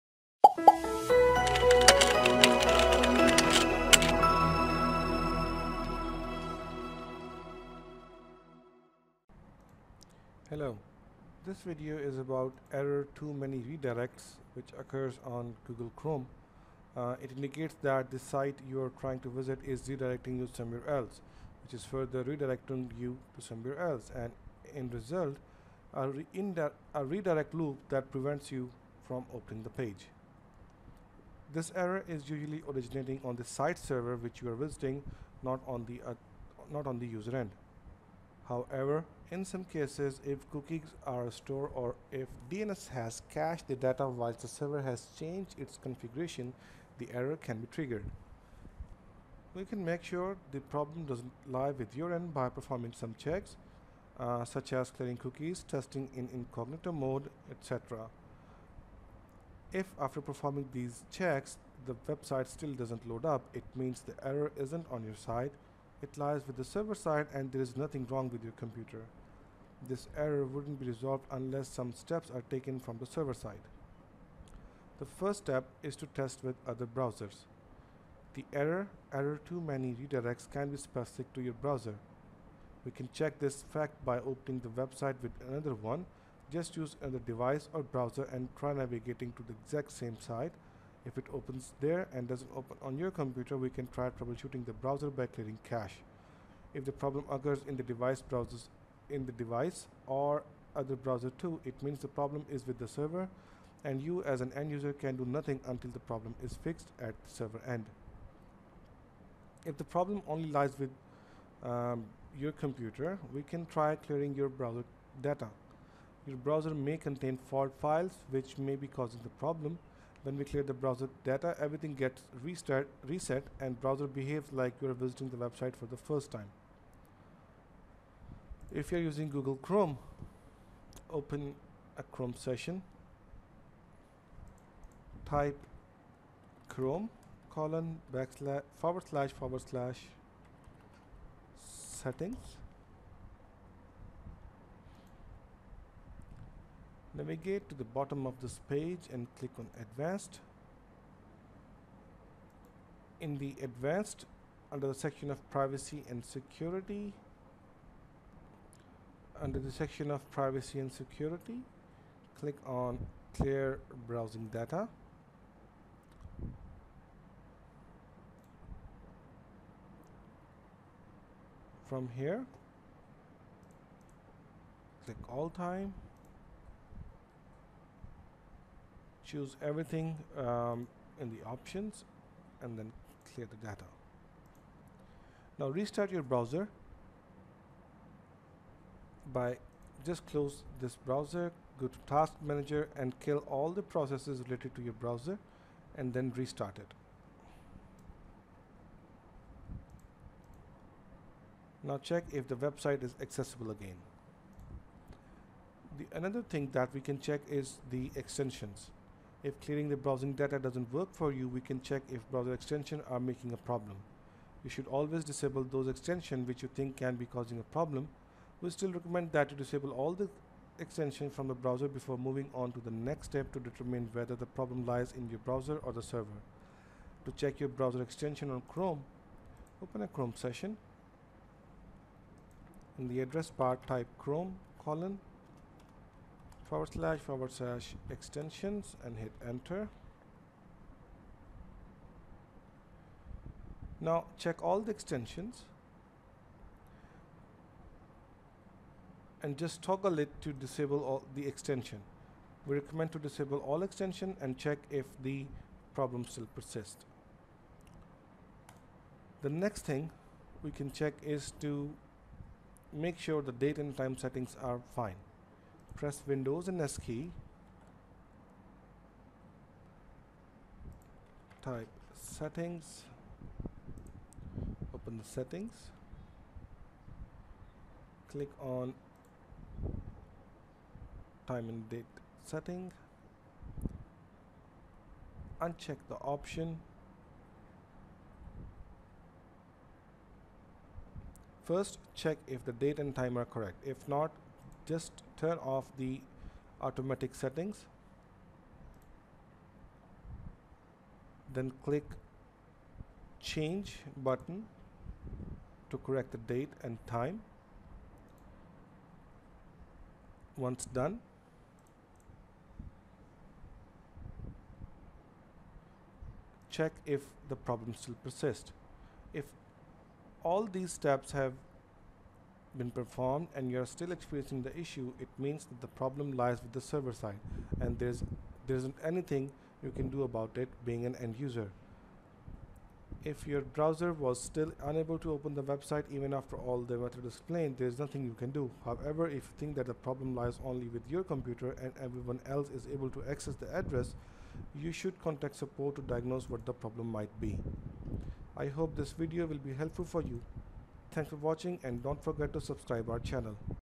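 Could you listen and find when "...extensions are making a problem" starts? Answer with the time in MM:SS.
03:32.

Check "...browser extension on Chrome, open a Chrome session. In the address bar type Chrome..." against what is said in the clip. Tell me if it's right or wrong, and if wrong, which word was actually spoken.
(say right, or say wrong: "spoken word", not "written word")
right.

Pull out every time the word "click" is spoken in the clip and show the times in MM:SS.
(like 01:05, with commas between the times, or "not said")
02:29, 02:42, 02:55, 04:38, 05:01.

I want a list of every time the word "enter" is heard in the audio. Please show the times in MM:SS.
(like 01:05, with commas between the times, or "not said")
03:59.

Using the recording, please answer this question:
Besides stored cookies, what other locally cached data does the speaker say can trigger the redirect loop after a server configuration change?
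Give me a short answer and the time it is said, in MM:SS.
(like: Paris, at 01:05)
DNS, at 00:42.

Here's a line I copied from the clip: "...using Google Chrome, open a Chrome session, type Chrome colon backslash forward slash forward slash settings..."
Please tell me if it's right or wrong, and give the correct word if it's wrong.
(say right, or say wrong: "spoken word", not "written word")
right.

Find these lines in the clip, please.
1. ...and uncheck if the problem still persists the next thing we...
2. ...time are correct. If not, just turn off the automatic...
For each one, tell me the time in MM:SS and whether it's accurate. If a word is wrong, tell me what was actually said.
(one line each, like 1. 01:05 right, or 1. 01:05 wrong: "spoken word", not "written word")
1. 04:14 wrong: "check", not "uncheck"
2. 04:53 right.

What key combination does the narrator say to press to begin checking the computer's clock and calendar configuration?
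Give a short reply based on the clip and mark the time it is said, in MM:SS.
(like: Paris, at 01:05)
Windows and S, at 04:26.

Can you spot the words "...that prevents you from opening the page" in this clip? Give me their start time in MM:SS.
00:27.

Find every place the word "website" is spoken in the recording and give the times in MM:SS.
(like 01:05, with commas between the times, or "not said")
01:02, 01:24, 02:05, 03:22, 05:35.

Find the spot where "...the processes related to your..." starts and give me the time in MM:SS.
03:13.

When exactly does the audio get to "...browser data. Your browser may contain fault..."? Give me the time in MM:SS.
01:54.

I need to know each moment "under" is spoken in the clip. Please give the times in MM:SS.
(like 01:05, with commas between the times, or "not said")
02:34, 02:39.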